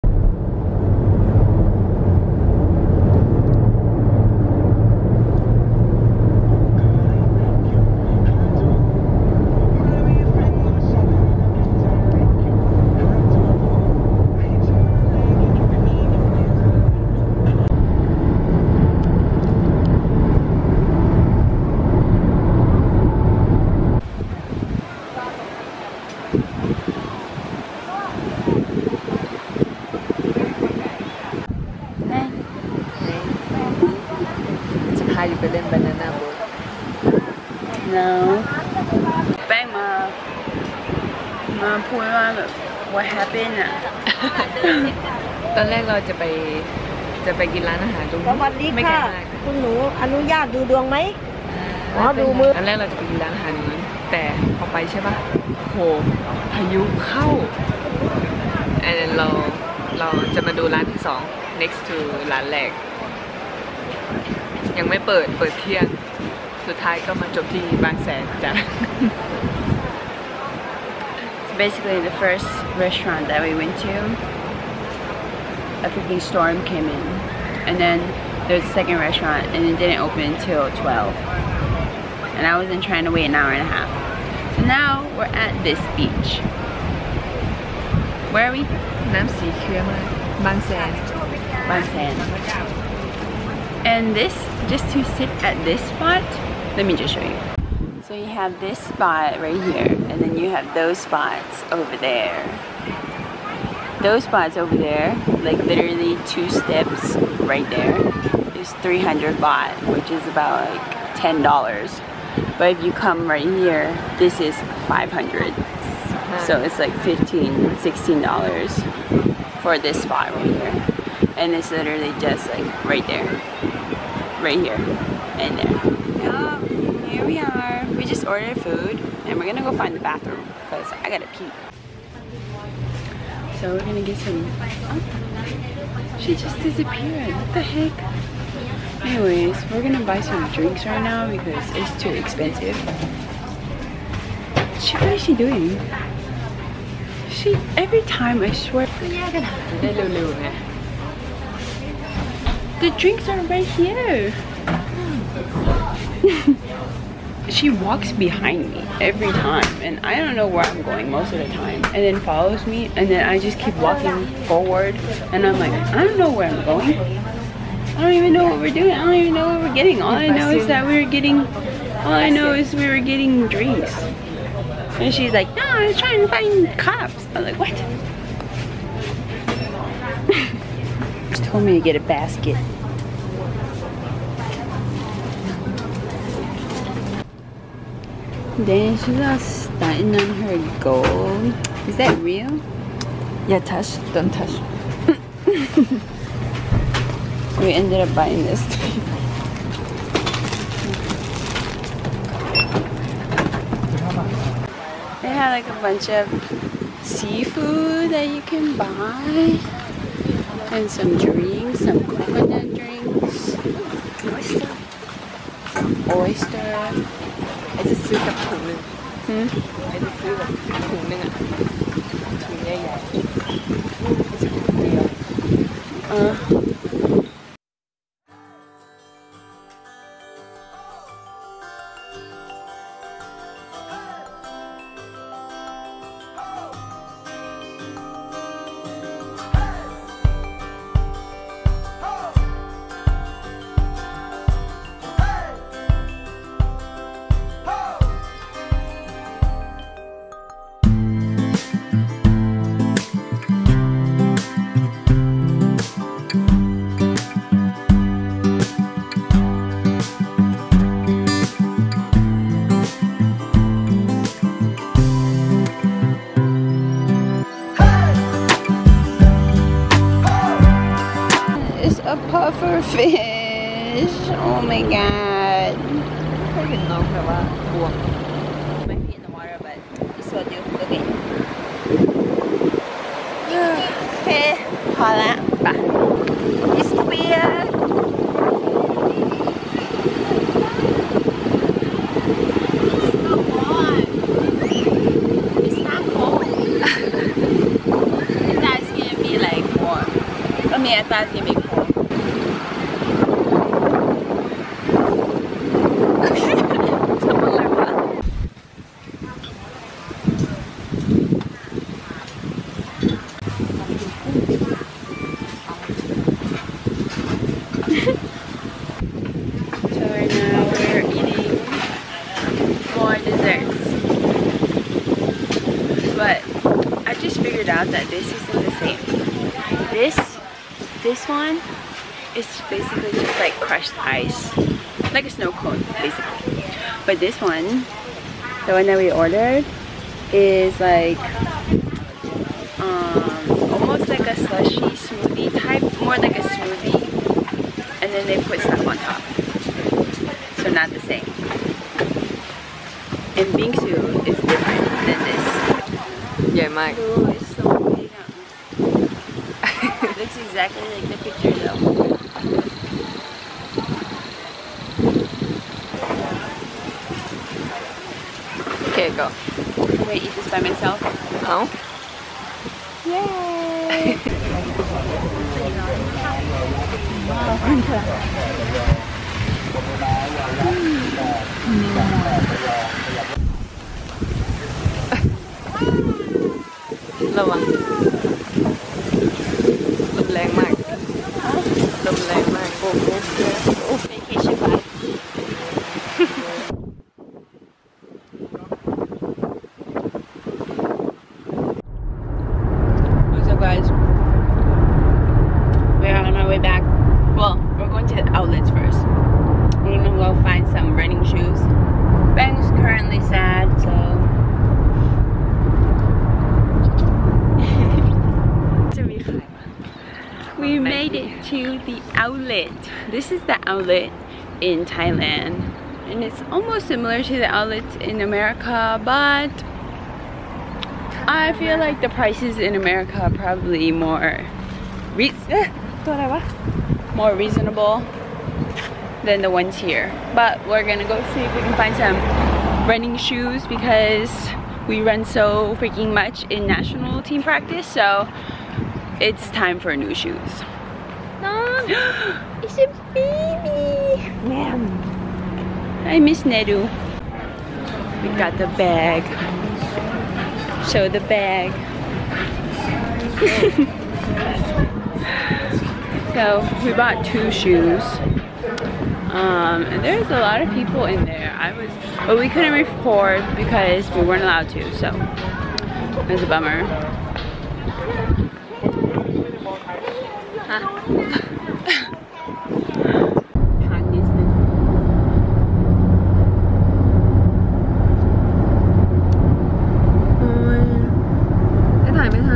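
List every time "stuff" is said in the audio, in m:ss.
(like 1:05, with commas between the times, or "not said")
5:48.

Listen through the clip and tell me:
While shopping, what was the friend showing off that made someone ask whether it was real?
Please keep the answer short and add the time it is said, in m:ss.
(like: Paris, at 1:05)
her gold, at 3:10.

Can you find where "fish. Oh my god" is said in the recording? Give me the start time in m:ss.
4:32.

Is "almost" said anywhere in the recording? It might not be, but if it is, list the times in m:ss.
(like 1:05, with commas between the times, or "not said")
5:43, 7:06.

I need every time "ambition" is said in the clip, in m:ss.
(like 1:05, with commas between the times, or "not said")
not said.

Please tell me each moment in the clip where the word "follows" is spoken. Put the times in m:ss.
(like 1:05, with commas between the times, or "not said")
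2:42.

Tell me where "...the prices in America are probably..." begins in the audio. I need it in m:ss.
7:12.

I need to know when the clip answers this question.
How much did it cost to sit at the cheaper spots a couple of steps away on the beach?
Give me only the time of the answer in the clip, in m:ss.
1:48.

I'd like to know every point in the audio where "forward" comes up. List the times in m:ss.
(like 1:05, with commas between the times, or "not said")
2:44.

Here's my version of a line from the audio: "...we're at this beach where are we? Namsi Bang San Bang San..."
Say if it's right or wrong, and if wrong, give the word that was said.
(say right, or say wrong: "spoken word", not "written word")
right.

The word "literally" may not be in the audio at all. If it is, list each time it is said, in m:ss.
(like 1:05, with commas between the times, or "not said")
1:45, 2:01.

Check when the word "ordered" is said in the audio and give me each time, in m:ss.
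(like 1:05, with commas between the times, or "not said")
2:08, 5:39.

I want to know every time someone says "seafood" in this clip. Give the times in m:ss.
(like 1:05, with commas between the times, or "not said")
3:27.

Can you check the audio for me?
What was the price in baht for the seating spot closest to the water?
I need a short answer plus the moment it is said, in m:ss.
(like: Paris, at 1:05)
500, at 1:54.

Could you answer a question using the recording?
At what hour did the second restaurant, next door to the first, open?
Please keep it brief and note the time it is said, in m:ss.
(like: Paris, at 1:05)
12, at 1:20.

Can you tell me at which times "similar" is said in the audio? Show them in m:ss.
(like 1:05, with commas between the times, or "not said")
7:06.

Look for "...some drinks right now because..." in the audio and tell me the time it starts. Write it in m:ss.
2:20.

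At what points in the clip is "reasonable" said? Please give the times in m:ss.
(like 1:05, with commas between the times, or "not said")
7:17.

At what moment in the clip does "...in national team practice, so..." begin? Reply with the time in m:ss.
7:26.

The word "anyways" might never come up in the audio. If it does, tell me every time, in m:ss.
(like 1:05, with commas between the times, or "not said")
2:19.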